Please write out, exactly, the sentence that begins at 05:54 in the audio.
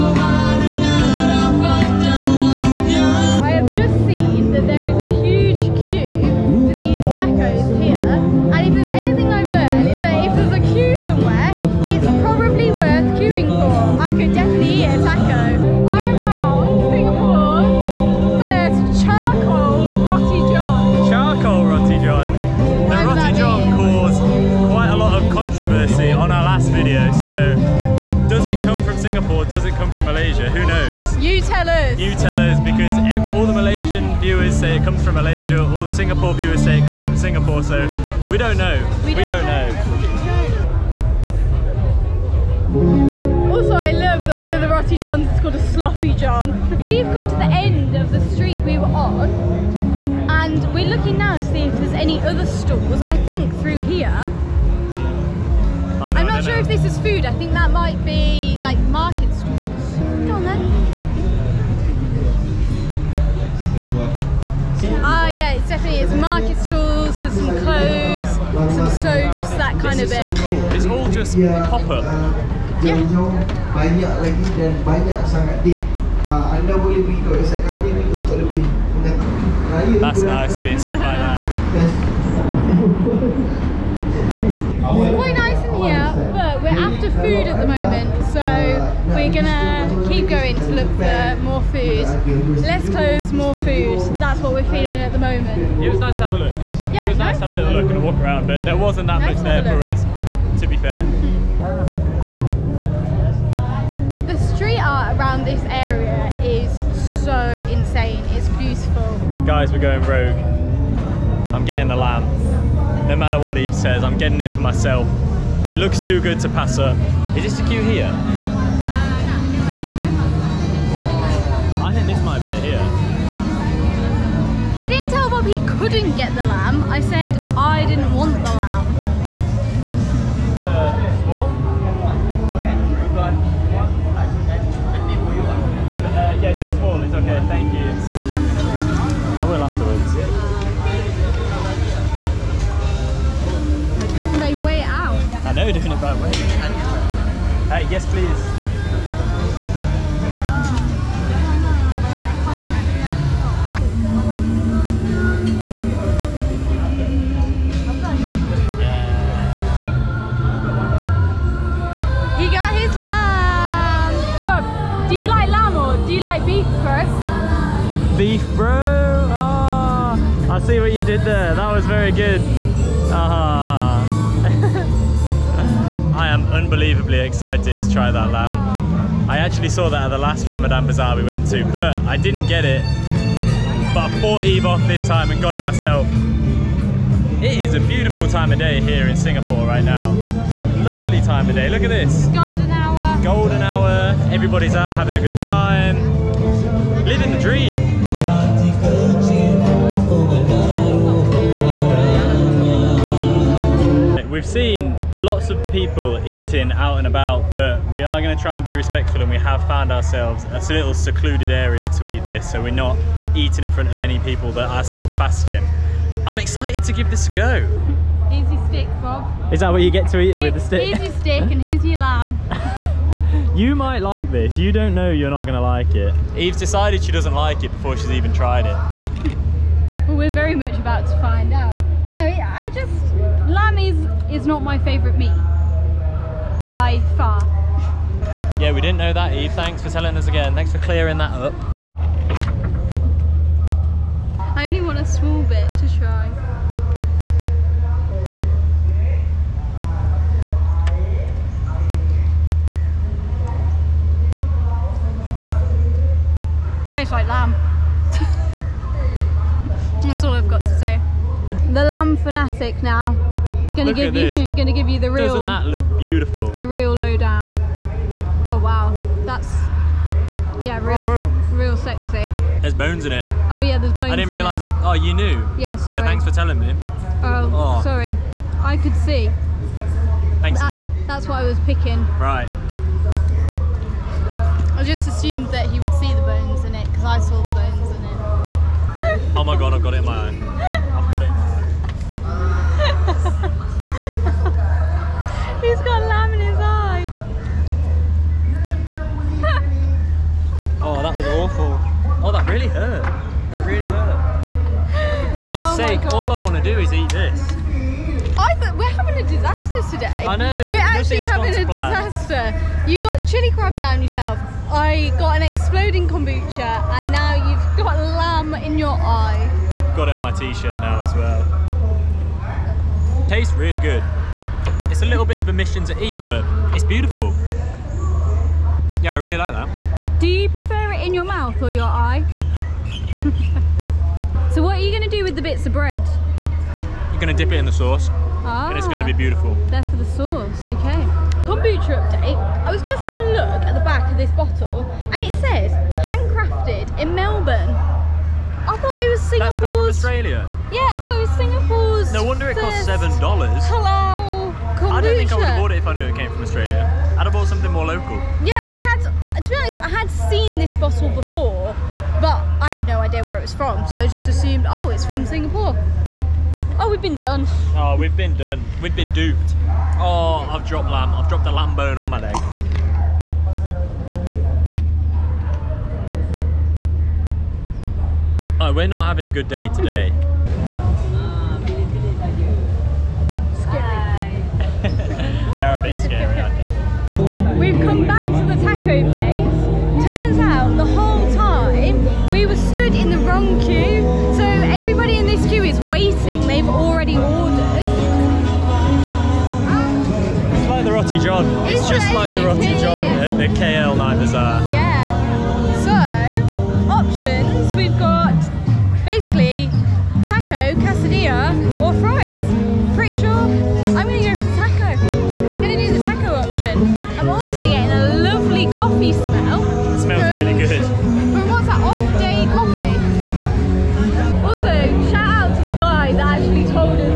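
I don't think I would have bought it if I knew it came from Australia.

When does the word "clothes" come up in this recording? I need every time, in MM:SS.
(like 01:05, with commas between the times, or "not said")
01:07, 01:32.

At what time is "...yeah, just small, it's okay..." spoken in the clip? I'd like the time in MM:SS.
02:16.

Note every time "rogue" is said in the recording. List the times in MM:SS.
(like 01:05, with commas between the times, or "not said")
01:50.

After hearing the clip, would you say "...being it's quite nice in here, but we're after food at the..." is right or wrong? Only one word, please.
right.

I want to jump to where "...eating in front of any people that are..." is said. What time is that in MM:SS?
03:33.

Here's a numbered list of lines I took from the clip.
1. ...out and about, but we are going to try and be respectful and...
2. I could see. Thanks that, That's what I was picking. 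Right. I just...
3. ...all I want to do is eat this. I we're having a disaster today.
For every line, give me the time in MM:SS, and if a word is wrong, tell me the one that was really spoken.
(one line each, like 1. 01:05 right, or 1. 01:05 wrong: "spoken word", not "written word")
1. 03:26 right
2. 04:38 right
3. 05:06 right.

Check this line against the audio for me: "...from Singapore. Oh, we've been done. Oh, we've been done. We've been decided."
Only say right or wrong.
wrong.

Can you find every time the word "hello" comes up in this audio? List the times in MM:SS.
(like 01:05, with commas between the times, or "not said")
not said.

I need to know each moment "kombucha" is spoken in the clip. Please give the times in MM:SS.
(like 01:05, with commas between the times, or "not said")
05:16, 05:41, 05:54.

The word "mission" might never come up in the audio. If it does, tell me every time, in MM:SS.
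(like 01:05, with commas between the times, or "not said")
05:25.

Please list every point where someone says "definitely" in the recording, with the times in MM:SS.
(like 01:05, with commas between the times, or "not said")
01:05.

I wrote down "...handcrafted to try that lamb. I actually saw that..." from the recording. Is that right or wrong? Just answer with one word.
wrong.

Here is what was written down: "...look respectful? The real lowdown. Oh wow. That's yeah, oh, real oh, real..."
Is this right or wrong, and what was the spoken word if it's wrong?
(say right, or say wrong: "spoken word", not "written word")
wrong: "beautiful", not "respectful".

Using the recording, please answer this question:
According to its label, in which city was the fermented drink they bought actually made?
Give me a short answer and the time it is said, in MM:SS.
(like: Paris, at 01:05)
Melbourne, at 05:47.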